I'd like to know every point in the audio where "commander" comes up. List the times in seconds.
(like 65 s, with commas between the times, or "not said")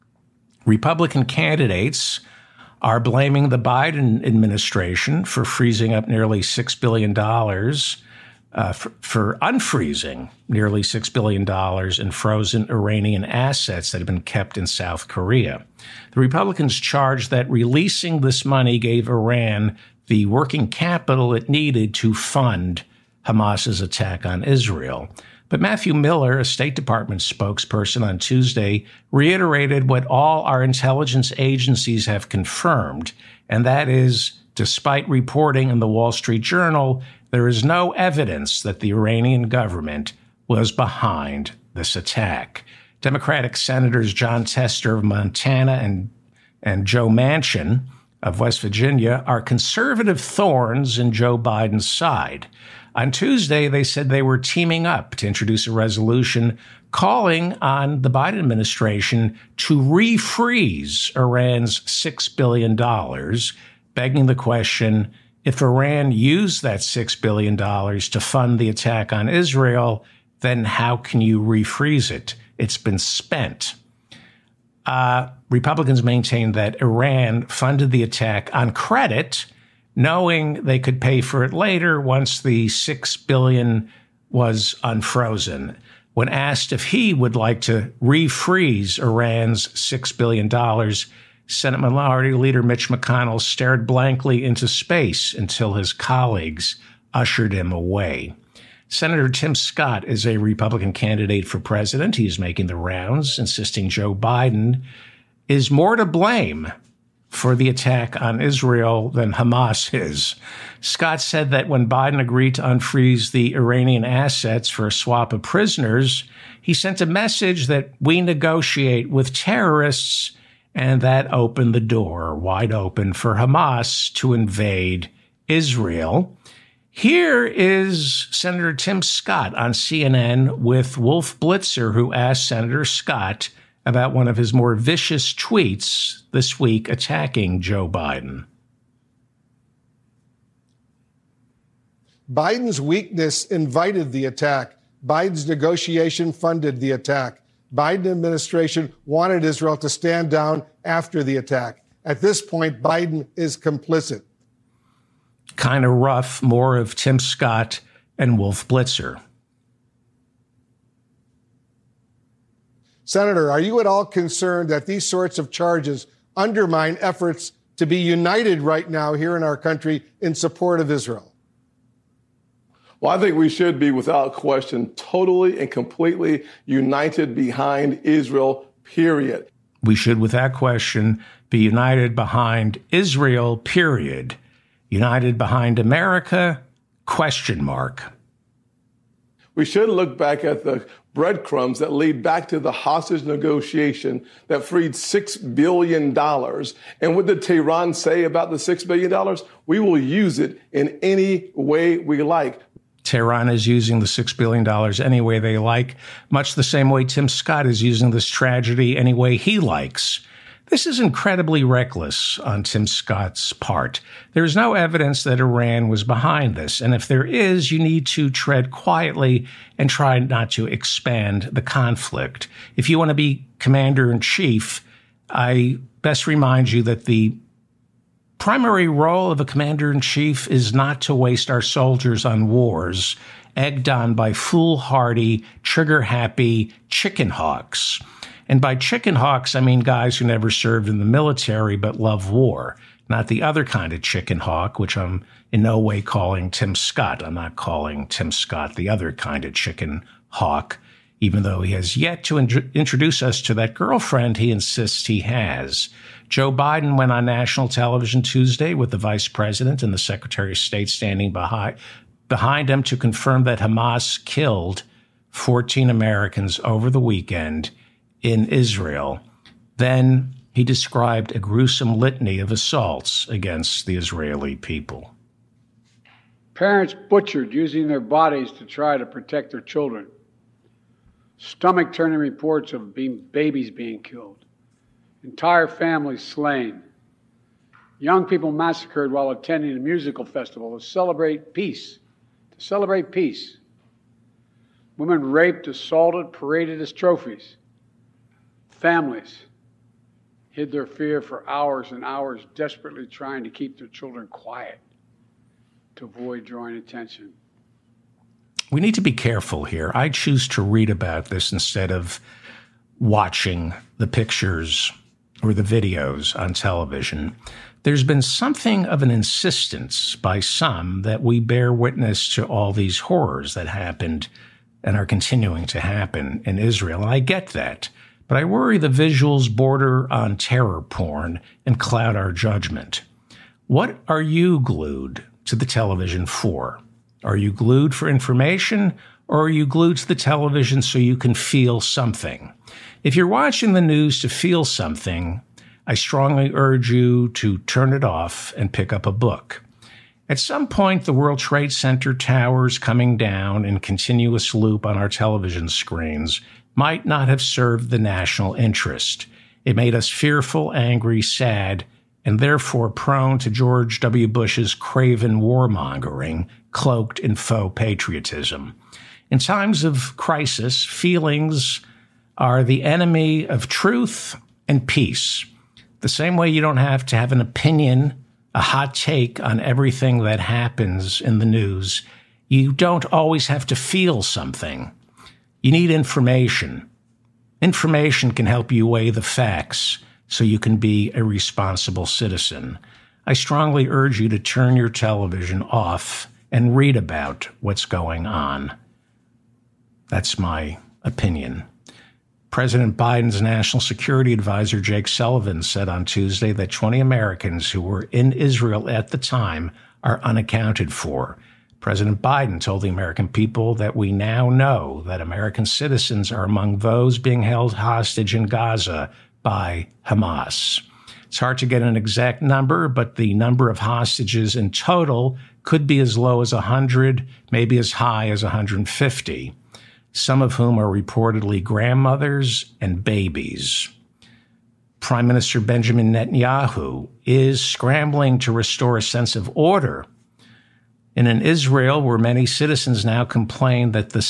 223 s, 229 s.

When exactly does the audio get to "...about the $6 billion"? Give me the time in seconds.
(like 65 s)
198 s.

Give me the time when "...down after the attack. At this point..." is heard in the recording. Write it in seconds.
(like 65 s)
150 s.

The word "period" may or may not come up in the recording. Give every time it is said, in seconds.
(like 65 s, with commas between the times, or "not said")
178 s, 183 s.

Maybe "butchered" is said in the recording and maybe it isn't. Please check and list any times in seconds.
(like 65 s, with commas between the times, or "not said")
277 s.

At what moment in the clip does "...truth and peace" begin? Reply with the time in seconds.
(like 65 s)
373 s.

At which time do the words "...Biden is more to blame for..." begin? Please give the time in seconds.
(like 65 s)
104 s.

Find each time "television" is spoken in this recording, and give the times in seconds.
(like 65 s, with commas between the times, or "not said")
257 s, 316 s, 335 s, 340 s, 355 s, 394 s.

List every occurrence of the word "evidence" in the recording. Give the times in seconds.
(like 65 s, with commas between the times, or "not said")
37 s, 214 s.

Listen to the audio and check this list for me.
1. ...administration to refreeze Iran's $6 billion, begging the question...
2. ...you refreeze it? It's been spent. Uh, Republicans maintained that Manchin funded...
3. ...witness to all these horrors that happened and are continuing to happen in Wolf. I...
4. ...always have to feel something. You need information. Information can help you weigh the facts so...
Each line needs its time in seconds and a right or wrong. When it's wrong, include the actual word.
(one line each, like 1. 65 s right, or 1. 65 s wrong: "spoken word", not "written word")
1. 58 s right
2. 71 s wrong: "Iran", not "Manchin"
3. 321 s wrong: "Israel", not "Wolf"
4. 383 s right.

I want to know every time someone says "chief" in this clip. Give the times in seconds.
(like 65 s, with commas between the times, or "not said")
224 s, 230 s.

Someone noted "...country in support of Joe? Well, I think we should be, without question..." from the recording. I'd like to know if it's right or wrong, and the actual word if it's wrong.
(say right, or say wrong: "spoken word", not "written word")
wrong: "Israel", not "Joe".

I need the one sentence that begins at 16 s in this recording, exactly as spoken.
The Republicans charge that releasing this money gave Iran the working capital it needed to fund Hamas's attack on Israel.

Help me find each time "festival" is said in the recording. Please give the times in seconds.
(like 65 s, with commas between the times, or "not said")
290 s.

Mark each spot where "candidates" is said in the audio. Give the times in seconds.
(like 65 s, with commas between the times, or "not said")
1 s, 100 s.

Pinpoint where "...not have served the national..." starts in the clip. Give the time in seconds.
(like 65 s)
357 s.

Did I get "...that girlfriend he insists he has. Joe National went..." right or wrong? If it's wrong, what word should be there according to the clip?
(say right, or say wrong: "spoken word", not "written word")
wrong: "Biden", not "National".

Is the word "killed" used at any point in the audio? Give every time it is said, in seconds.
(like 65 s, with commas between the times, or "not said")
264 s, 284 s.